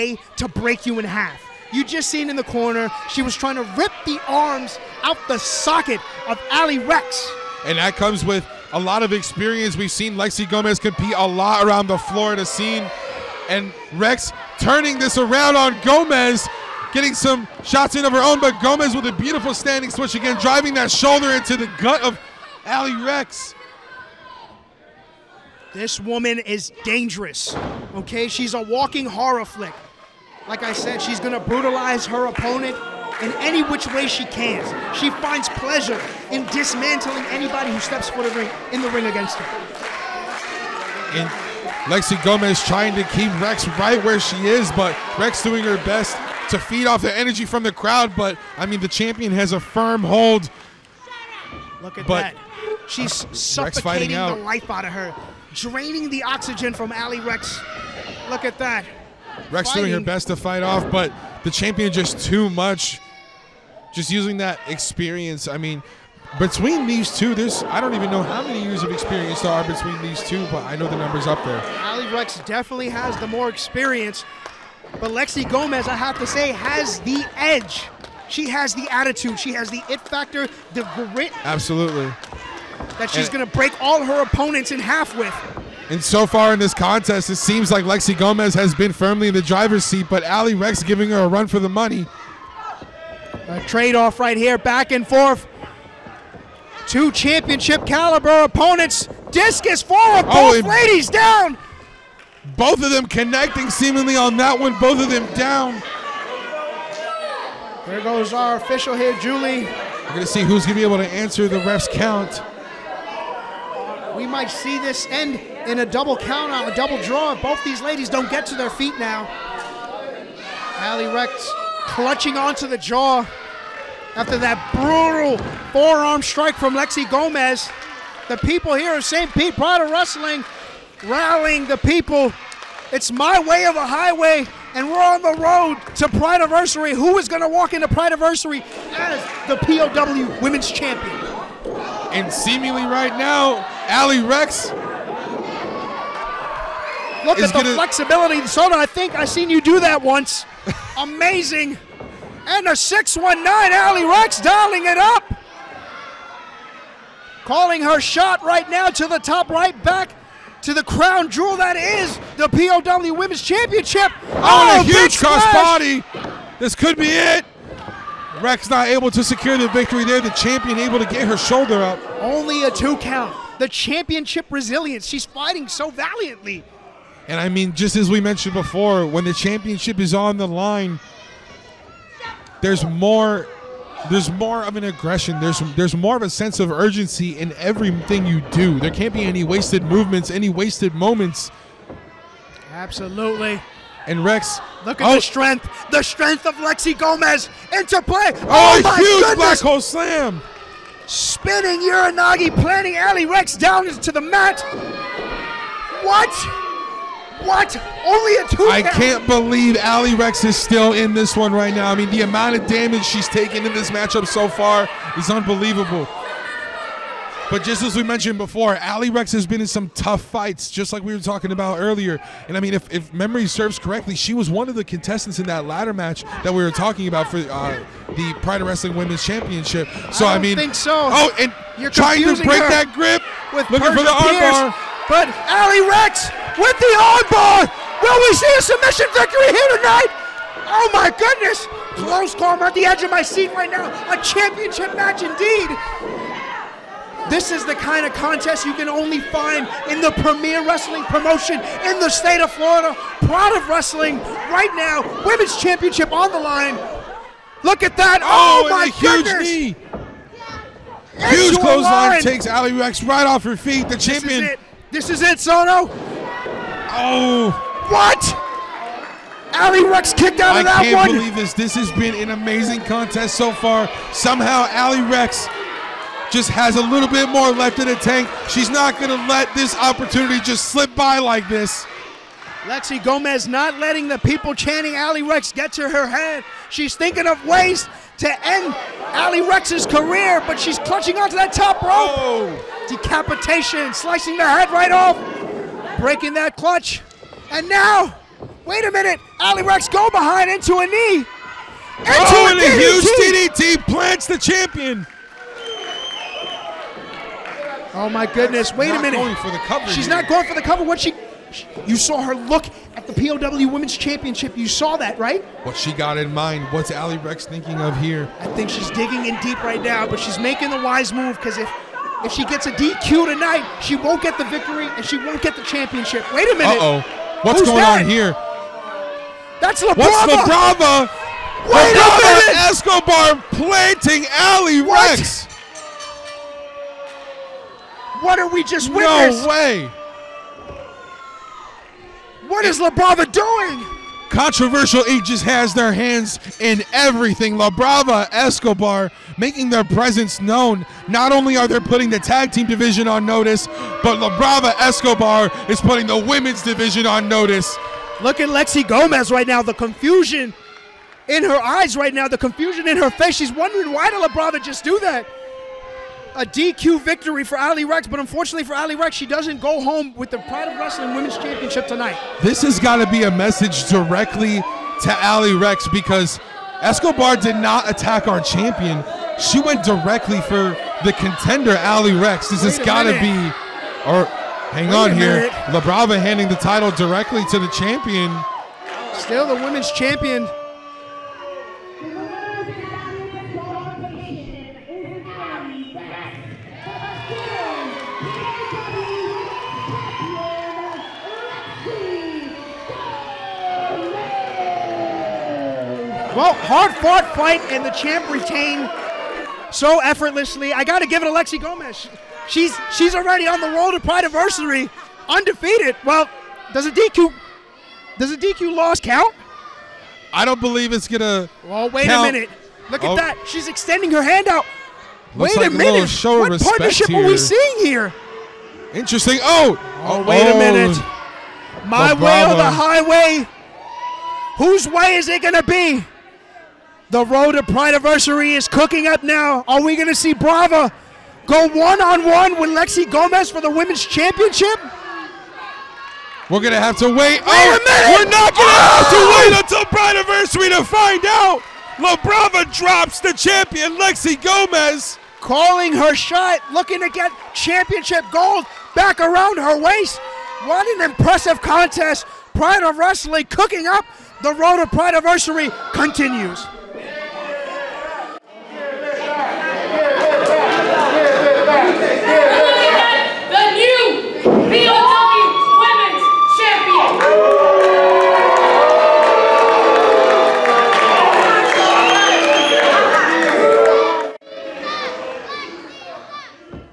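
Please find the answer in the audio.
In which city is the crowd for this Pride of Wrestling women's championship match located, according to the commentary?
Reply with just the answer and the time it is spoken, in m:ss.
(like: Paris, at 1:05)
St. Pete, at 2:09.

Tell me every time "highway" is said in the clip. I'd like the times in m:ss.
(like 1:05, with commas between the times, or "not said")
2:13, 7:12.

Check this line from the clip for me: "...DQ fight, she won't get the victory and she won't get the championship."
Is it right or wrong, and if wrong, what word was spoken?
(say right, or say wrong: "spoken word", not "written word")
wrong: "tonight", not "fight".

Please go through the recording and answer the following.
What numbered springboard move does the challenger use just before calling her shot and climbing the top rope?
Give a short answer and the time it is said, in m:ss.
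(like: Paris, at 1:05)
619, at 2:32.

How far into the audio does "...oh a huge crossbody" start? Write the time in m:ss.
2:44.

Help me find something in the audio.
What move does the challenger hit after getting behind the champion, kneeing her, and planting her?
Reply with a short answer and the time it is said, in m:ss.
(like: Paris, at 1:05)
TDT, at 5:03.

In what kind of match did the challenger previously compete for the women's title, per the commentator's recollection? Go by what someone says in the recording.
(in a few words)
Ladder match.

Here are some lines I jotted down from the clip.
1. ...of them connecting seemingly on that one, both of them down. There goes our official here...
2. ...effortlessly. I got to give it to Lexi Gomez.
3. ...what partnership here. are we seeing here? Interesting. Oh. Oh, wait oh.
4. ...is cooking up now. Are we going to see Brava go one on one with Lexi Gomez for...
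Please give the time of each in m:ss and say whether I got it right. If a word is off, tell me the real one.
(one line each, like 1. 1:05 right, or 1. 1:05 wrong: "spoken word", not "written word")
1. 1:42 right
2. 6:49 right
3. 7:06 right
4. 7:18 right.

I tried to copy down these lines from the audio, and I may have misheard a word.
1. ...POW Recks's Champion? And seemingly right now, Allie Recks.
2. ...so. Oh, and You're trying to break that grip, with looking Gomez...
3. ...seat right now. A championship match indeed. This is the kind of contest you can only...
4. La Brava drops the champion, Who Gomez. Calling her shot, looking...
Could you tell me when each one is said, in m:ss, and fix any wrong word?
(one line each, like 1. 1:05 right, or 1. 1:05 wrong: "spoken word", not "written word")
1. 2:19 wrong: "Women", not "Recks"
2. 3:50 wrong: "Persia", not "Gomez"
3. 4:03 right
4. 7:31 wrong: "Lexi", not "Who".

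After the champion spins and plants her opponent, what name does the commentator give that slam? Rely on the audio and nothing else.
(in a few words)
Black hole slam.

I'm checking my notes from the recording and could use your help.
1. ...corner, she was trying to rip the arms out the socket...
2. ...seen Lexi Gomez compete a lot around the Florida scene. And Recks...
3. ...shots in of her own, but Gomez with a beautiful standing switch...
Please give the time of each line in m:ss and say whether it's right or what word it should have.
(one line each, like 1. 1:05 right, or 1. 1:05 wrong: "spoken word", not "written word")
1. 0:02 right
2. 0:09 right
3. 0:17 right.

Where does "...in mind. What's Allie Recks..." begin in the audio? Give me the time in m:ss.
5:16.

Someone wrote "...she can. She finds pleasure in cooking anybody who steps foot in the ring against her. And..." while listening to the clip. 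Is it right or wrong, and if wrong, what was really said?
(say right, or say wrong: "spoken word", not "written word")
wrong: "dismantling", not "cooking".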